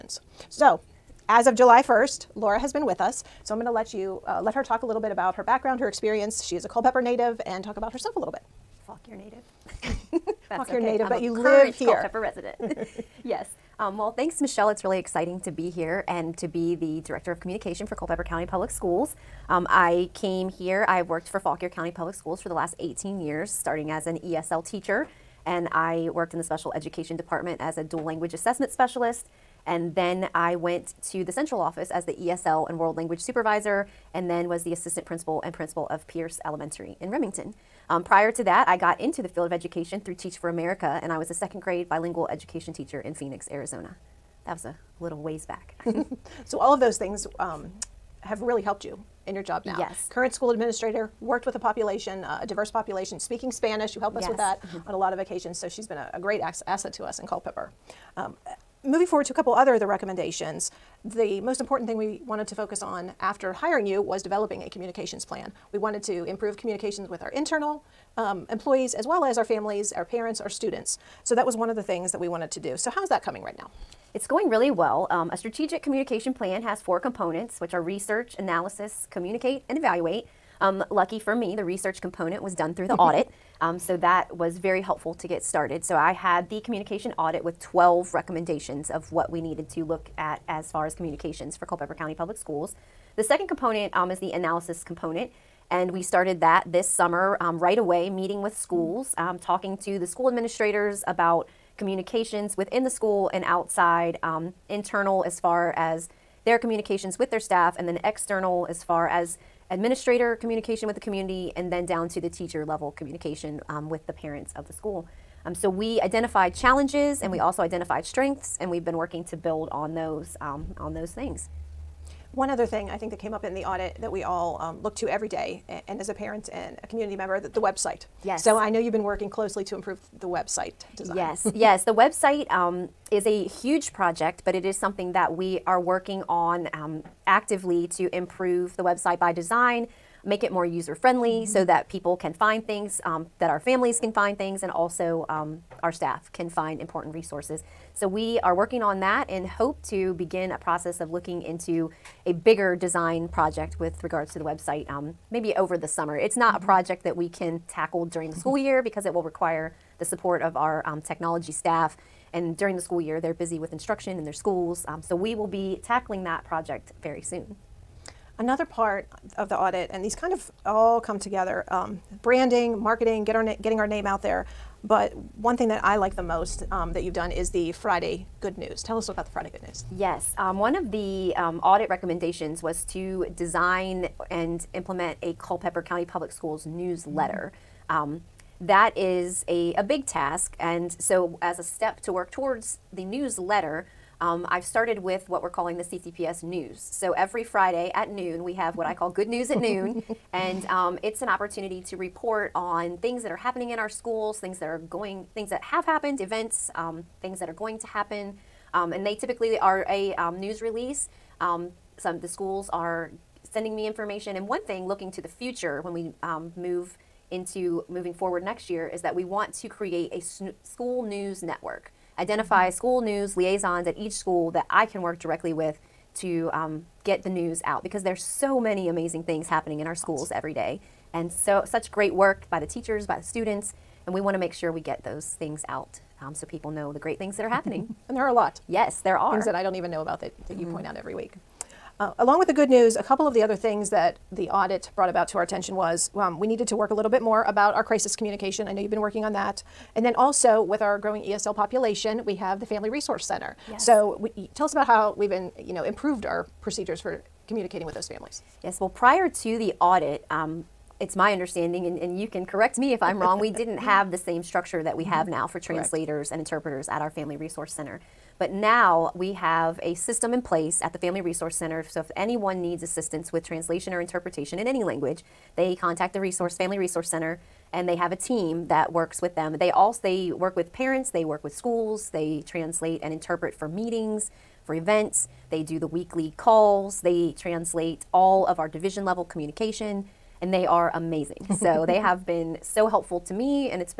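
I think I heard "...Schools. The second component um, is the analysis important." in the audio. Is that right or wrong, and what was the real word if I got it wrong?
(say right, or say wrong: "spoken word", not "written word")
wrong: "component", not "important".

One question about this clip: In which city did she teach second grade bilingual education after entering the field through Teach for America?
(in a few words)
Phoenix, Arizona.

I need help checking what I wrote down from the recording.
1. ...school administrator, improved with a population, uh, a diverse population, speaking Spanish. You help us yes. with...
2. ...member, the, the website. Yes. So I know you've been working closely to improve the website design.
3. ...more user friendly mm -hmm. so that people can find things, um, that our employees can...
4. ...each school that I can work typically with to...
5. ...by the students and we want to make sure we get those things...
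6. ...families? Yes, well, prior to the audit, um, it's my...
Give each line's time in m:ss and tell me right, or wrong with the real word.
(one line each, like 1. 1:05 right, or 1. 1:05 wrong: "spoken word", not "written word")
1. 0:50 wrong: "worked", not "improved"
2. 2:07 right
3. 2:20 wrong: "families", not "employees"
4. 3:43 wrong: "directly", not "typically"
5. 3:53 right
6. 4:18 right.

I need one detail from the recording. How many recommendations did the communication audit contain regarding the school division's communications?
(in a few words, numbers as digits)
12.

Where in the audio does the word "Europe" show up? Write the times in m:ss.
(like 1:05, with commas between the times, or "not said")
not said.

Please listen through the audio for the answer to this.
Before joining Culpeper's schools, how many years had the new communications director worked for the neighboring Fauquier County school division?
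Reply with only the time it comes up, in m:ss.
0:22.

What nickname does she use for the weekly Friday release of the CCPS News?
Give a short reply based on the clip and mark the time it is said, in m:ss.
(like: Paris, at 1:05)
Good News at Noon, at 3:19.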